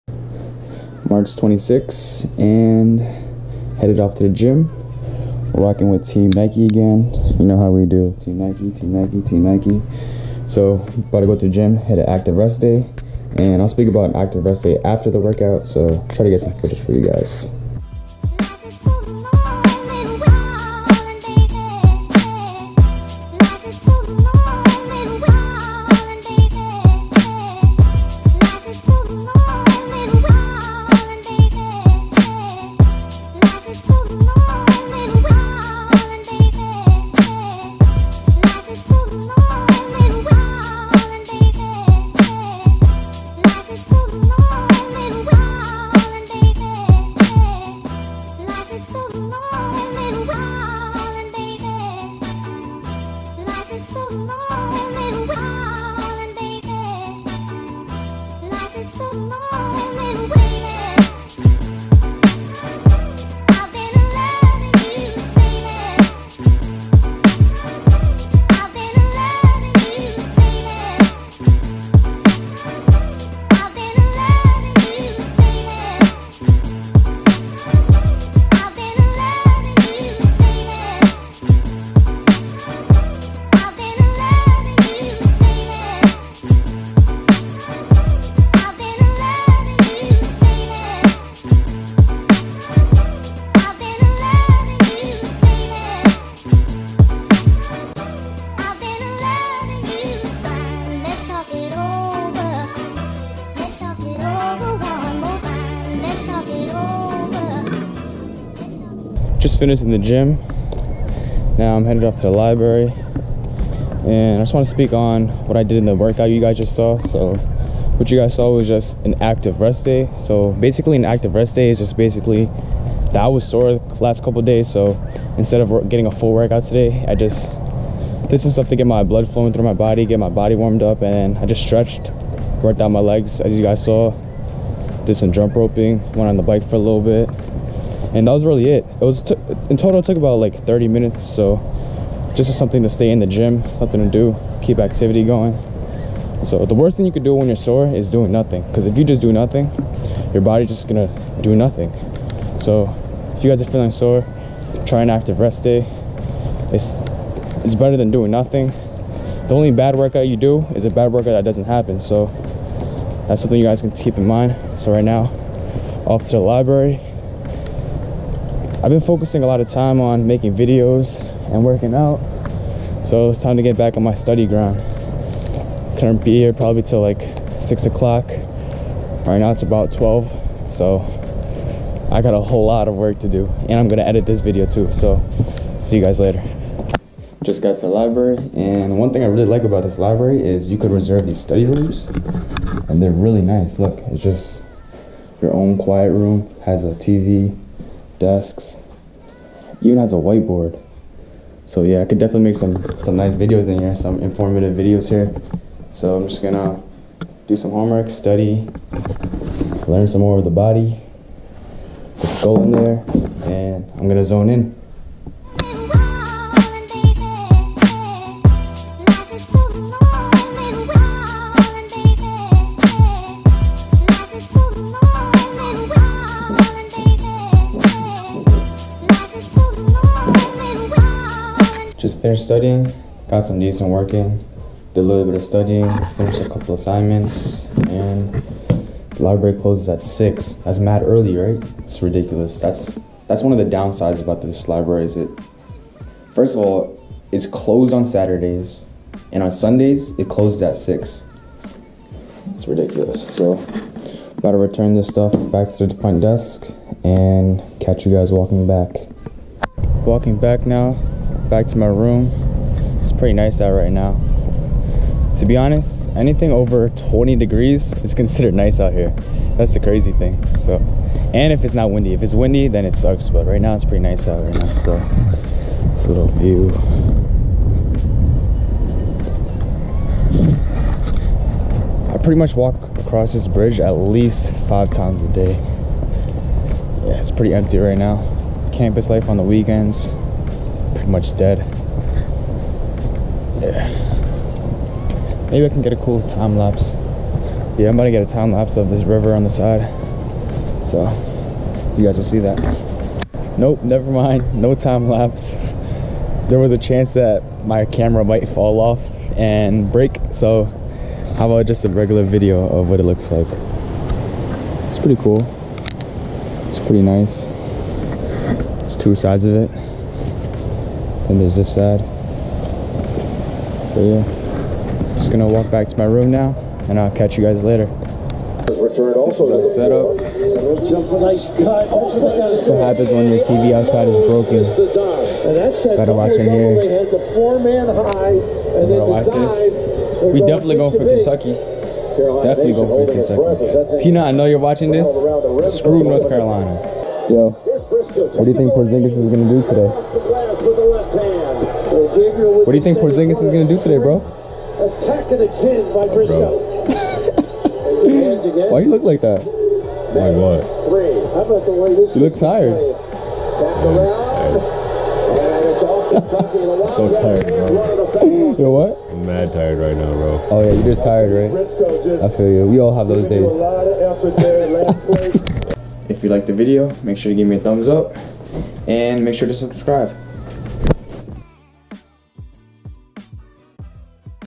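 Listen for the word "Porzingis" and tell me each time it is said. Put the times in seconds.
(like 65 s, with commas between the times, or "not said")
348 s, 352 s.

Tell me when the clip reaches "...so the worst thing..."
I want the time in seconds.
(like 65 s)
146 s.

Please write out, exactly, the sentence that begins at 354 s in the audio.
Attack to the chin by Briscoe.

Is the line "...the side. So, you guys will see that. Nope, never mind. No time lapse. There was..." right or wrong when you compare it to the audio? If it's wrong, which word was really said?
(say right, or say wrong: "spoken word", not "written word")
right.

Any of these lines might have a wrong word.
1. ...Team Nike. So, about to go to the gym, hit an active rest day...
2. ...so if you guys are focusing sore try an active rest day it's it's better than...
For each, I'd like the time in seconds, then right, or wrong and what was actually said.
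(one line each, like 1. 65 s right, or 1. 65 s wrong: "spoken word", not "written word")
1. 9 s right
2. 152 s wrong: "feeling", not "focusing".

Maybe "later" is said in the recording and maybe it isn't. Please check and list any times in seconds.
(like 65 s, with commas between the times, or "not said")
186 s, 327 s.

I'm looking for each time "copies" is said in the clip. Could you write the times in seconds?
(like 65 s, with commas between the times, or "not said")
not said.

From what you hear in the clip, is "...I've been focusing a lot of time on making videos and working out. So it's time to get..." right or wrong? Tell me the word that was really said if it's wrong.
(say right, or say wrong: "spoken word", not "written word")
right.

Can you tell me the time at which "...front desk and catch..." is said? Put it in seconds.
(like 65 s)
256 s.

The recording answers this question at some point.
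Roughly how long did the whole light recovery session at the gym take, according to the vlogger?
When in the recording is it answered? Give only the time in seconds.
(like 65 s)
140 s.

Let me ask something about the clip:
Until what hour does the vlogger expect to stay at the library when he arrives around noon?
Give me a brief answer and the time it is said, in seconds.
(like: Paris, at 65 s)
6 o'clock, at 177 s.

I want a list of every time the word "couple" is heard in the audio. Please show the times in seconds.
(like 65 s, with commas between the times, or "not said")
124 s, 236 s.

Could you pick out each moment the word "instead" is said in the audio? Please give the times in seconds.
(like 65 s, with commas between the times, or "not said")
125 s.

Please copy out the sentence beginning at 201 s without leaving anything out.
So yeah, I could definitely make some, some nice videos in here, some informative videos here.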